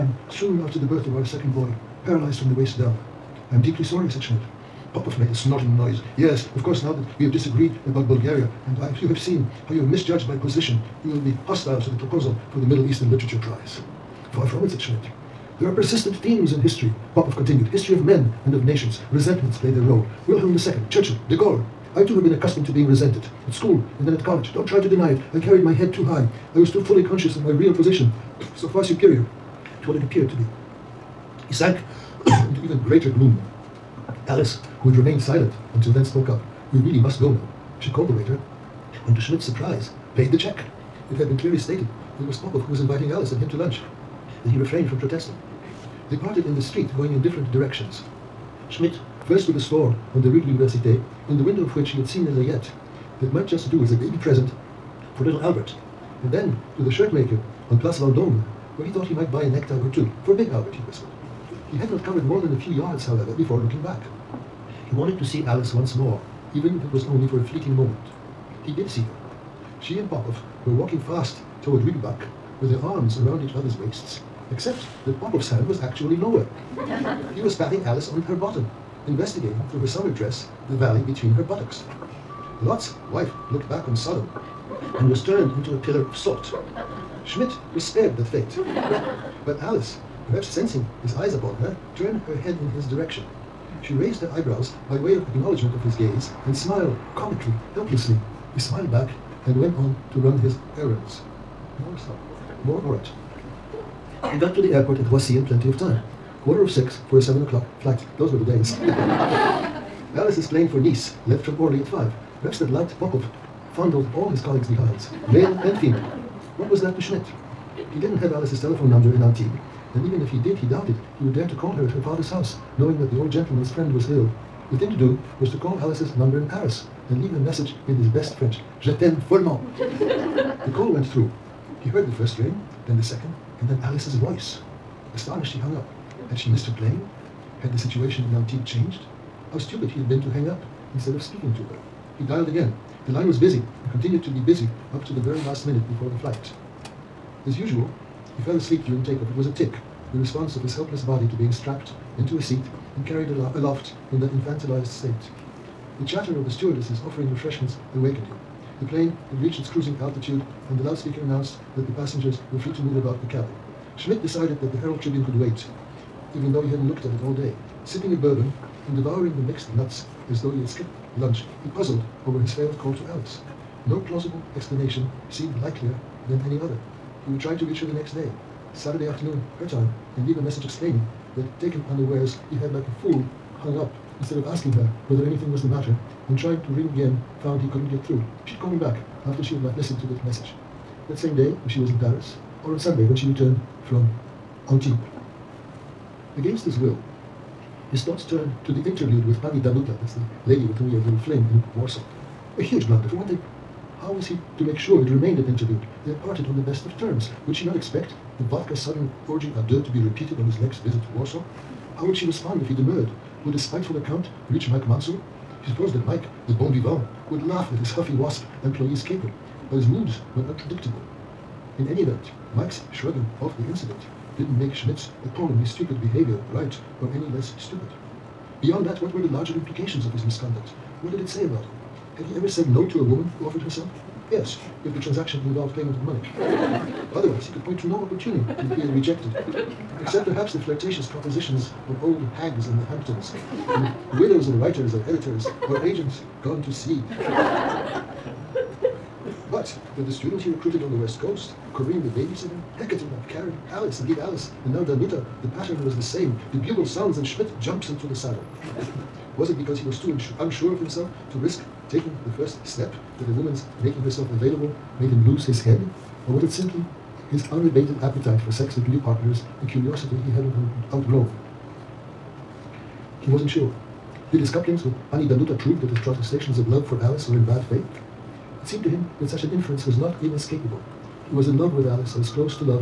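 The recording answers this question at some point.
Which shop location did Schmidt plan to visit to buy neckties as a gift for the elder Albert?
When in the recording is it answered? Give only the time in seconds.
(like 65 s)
57 s.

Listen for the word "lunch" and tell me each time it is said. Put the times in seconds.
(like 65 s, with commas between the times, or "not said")
43 s, 171 s.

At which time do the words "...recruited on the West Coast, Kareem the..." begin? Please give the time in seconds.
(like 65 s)
250 s.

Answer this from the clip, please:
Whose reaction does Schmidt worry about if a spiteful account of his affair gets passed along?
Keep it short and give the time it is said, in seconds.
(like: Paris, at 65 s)
Mike Mansour, at 214 s.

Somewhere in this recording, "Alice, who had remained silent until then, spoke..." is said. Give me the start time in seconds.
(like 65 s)
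34 s.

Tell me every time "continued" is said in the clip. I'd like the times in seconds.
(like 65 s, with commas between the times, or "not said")
17 s, 143 s.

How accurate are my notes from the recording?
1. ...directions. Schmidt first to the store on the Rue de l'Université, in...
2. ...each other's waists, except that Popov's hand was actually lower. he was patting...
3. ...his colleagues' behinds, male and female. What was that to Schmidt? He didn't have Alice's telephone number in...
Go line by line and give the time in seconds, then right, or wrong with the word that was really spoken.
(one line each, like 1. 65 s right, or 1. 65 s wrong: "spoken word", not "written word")
1. 47 s right
2. 73 s right
3. 114 s right.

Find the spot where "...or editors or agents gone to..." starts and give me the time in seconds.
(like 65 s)
244 s.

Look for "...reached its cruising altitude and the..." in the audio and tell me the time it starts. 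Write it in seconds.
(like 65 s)
159 s.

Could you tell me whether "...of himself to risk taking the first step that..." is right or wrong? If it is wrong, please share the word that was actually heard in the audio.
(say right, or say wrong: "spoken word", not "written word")
right.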